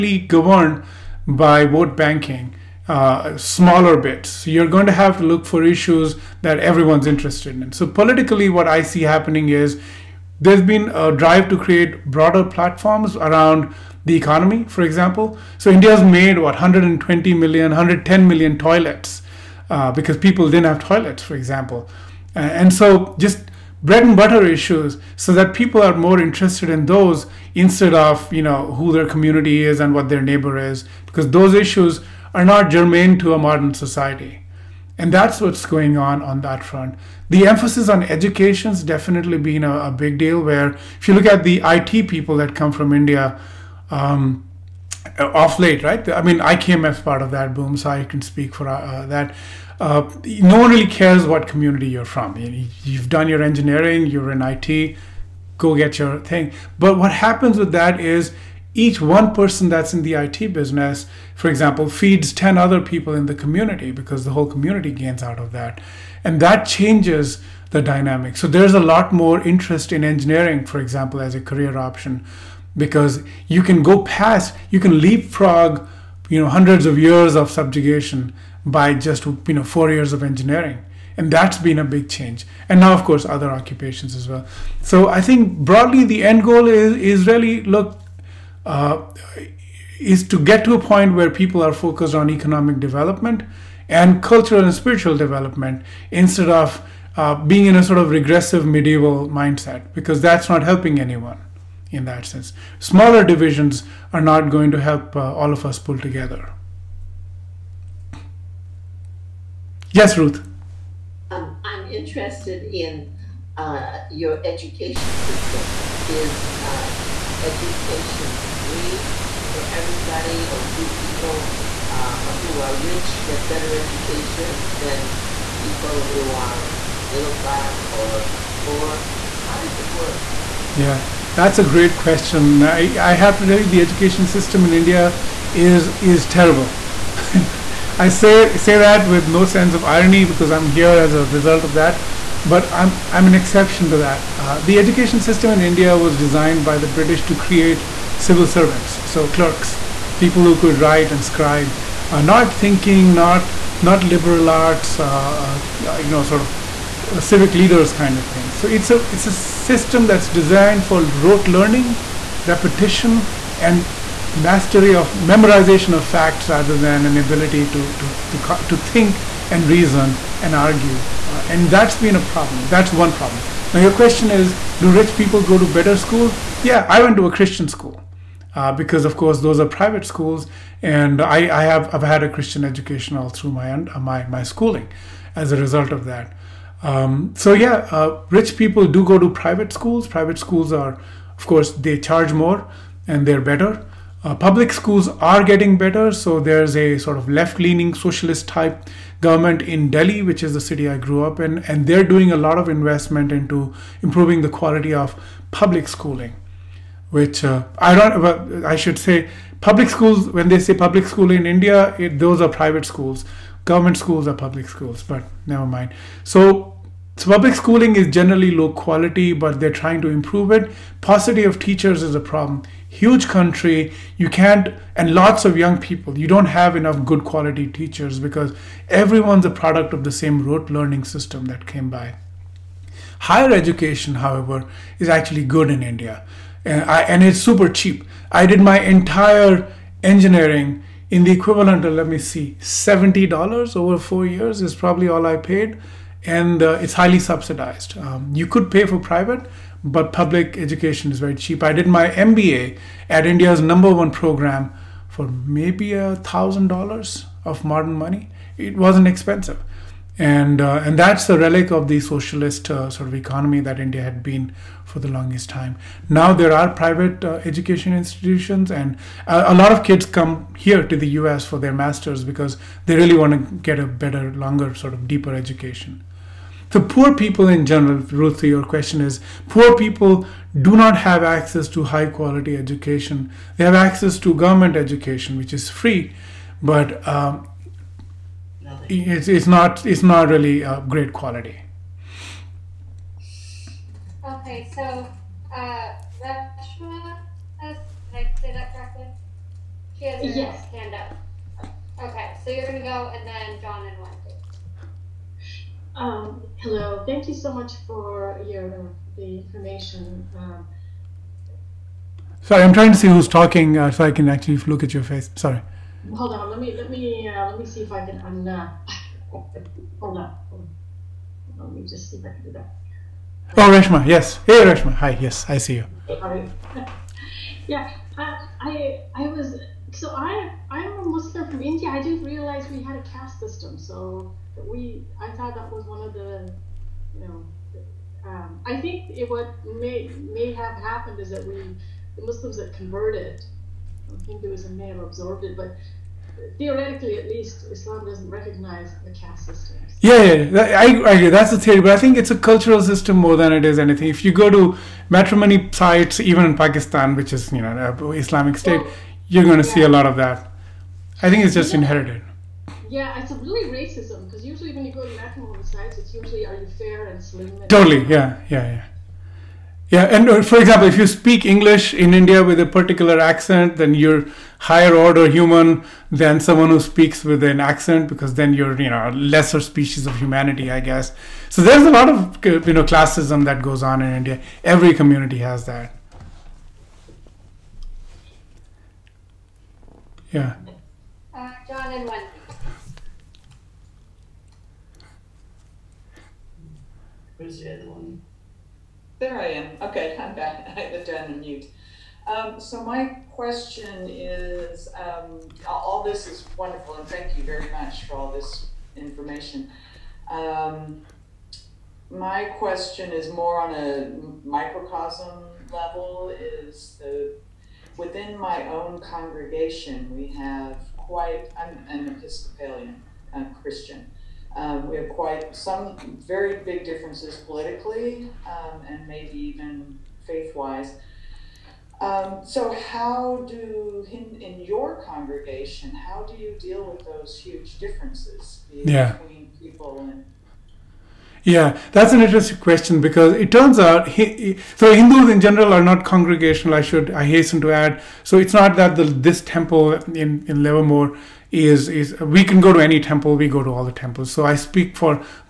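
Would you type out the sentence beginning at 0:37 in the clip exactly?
The emphasis on education's definitely been a, a big deal.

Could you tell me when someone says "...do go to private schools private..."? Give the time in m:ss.
3:08.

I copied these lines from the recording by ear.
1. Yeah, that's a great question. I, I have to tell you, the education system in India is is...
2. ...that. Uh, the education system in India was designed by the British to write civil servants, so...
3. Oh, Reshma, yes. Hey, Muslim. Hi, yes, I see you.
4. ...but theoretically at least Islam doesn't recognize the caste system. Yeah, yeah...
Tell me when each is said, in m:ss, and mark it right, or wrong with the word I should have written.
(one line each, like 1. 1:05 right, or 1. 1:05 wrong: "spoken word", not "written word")
1. 2:10 right
2. 2:23 wrong: "create", not "write"
3. 5:23 wrong: "Reshma", not "Muslim"
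4. 5:45 right.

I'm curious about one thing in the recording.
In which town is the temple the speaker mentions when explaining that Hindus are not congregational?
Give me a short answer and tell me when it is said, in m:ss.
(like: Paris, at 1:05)
Livermore, at 7:30.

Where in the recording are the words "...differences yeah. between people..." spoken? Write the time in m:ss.
7:17.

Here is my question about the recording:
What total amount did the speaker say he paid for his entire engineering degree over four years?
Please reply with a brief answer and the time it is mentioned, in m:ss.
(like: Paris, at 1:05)
$70, at 4:02.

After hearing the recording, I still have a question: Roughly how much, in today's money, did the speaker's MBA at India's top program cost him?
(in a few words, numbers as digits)
$1,000.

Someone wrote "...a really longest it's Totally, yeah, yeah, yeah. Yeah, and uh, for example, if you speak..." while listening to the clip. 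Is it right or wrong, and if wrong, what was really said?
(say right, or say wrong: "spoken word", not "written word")
wrong: "racist", not "longest".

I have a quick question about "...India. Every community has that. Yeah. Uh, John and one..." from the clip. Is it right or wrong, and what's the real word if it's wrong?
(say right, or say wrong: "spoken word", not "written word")
right.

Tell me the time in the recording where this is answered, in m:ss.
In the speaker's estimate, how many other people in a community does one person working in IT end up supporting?
1:02.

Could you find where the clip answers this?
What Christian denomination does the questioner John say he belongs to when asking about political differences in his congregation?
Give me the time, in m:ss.
7:02.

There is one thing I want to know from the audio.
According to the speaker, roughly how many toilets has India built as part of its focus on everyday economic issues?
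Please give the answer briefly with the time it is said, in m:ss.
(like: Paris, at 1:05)
110 million, at 0:17.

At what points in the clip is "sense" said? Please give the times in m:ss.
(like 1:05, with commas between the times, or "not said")
1:42, 2:19.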